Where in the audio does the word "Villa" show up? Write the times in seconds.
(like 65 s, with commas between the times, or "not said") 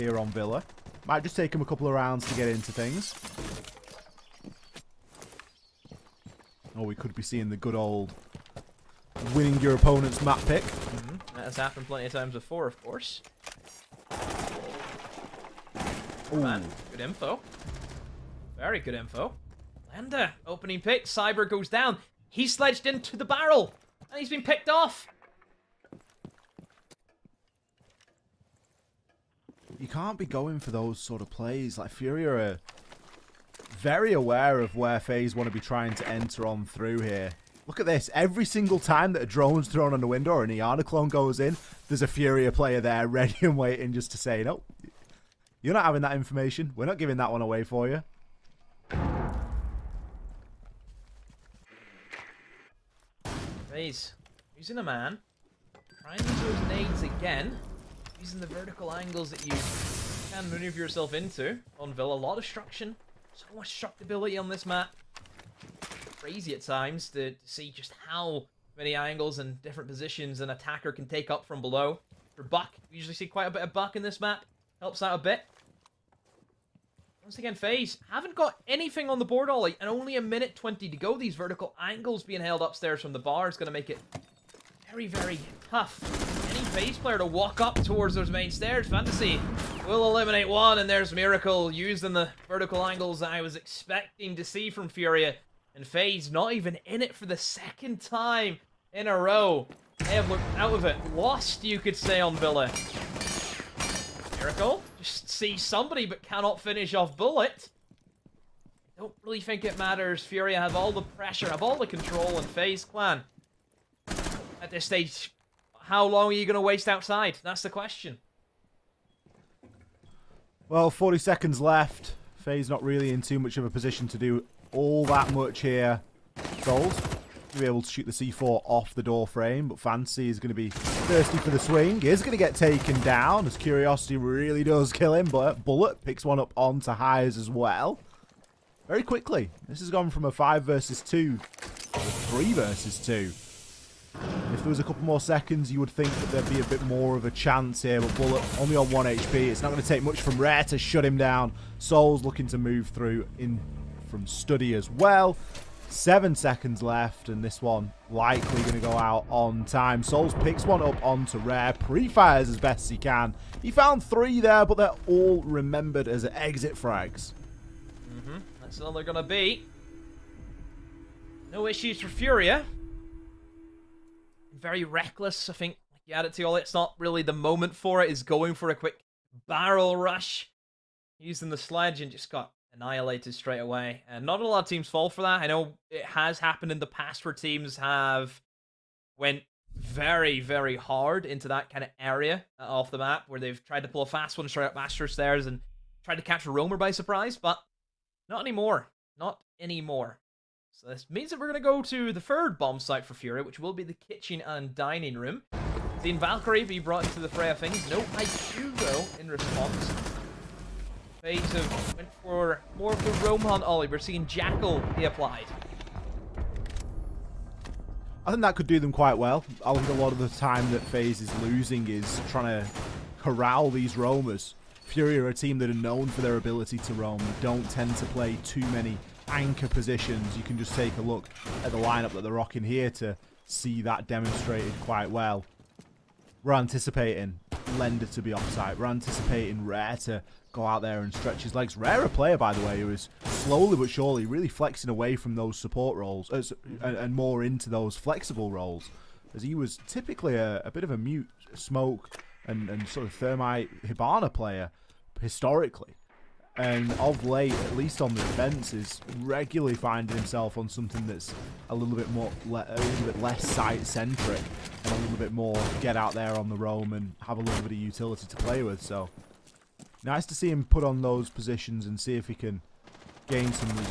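0 s, 61 s, 102 s.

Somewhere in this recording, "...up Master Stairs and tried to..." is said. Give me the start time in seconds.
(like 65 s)
194 s.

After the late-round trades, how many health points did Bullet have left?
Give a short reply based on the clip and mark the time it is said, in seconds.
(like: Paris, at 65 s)
1, at 148 s.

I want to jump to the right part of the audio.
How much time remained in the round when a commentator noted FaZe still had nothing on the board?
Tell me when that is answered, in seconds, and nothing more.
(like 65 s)
80 s.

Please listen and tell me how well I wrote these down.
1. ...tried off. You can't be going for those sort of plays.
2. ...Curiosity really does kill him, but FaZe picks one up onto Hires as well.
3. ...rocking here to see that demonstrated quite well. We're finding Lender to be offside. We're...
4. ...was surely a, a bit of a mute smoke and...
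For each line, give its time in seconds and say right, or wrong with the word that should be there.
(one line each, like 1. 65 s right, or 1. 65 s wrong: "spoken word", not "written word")
1. 24 s wrong: "picked", not "tried"
2. 133 s wrong: "Bullet", not "FaZe"
3. 232 s wrong: "anticipating", not "finding"
4. 249 s wrong: "typically", not "surely".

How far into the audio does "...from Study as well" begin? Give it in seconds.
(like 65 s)
154 s.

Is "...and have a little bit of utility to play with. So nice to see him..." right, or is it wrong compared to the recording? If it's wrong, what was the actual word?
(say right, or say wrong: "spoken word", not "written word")
right.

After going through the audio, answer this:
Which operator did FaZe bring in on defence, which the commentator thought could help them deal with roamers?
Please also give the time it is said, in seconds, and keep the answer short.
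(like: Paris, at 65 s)
Jackal, at 214 s.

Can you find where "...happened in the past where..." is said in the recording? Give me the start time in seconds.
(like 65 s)
186 s.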